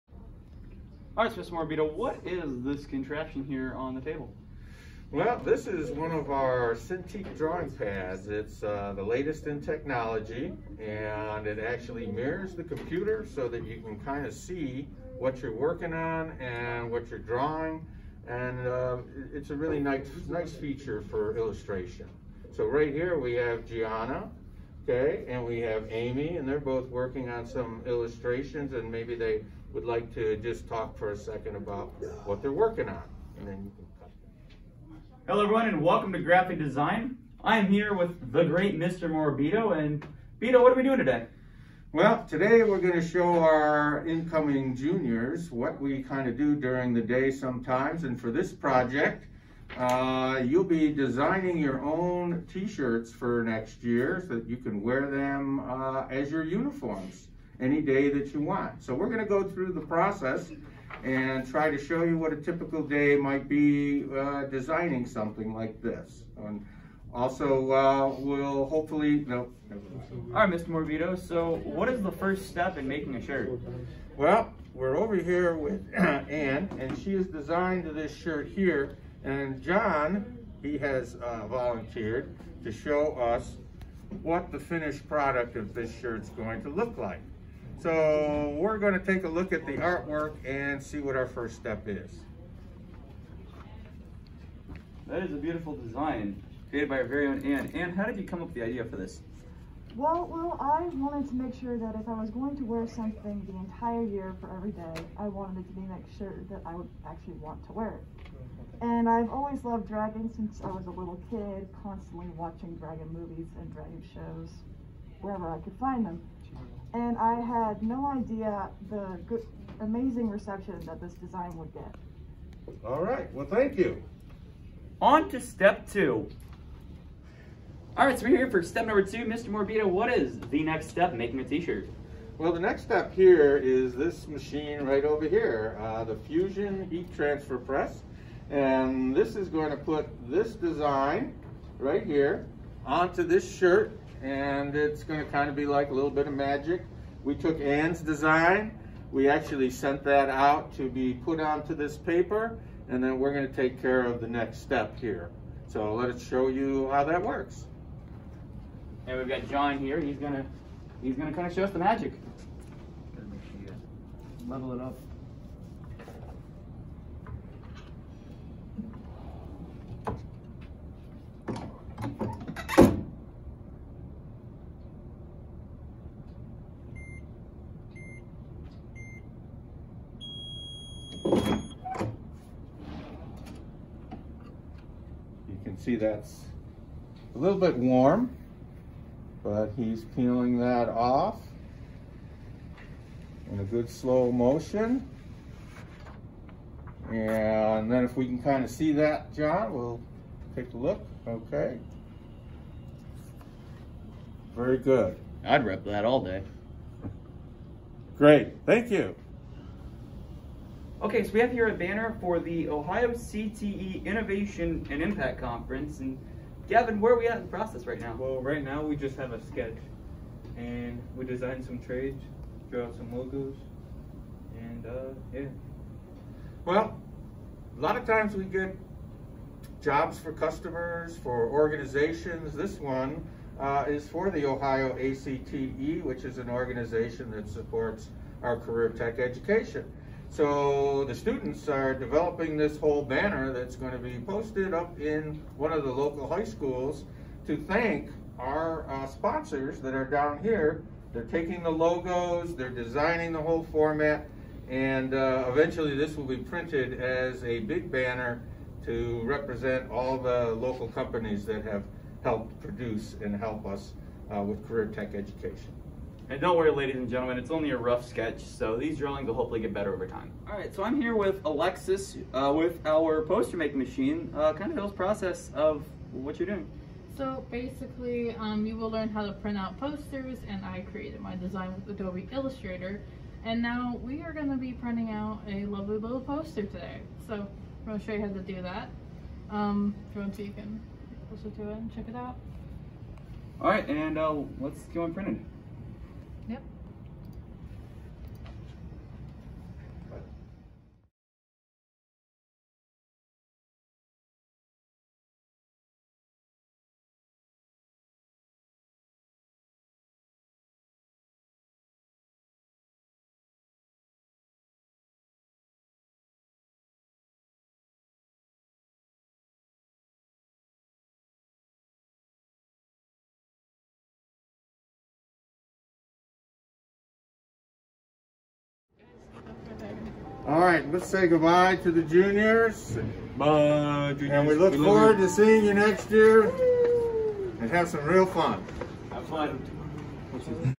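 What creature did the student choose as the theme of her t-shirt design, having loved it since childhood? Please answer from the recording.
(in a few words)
Dragons.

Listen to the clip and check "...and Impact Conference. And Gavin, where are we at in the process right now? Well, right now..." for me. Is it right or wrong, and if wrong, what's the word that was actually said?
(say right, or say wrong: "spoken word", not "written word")
right.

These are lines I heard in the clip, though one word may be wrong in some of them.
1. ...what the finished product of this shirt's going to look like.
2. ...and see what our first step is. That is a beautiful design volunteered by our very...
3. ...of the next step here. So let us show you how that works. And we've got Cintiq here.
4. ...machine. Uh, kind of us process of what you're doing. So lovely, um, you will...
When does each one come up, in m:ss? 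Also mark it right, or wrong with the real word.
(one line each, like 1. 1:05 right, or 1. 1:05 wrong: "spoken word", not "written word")
1. 1:24 right
2. 1:30 wrong: "created", not "volunteered"
3. 2:34 wrong: "John", not "Cintiq"
4. 4:33 wrong: "basically", not "lovely".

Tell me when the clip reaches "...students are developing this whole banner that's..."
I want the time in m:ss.
4:01.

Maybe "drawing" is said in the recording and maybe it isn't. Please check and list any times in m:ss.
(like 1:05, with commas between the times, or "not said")
0:07, 0:17, 4:28.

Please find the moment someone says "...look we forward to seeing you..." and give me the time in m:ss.
5:34.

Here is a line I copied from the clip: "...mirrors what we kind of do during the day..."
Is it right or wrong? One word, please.
wrong.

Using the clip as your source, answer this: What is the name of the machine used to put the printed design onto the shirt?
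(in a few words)
Fusion Heat Transfer Press.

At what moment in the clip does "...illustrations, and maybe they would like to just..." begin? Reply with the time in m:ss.
0:27.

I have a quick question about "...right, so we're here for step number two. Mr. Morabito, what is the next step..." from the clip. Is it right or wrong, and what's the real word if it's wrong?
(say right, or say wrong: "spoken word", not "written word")
right.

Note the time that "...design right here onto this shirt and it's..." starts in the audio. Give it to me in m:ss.
2:20.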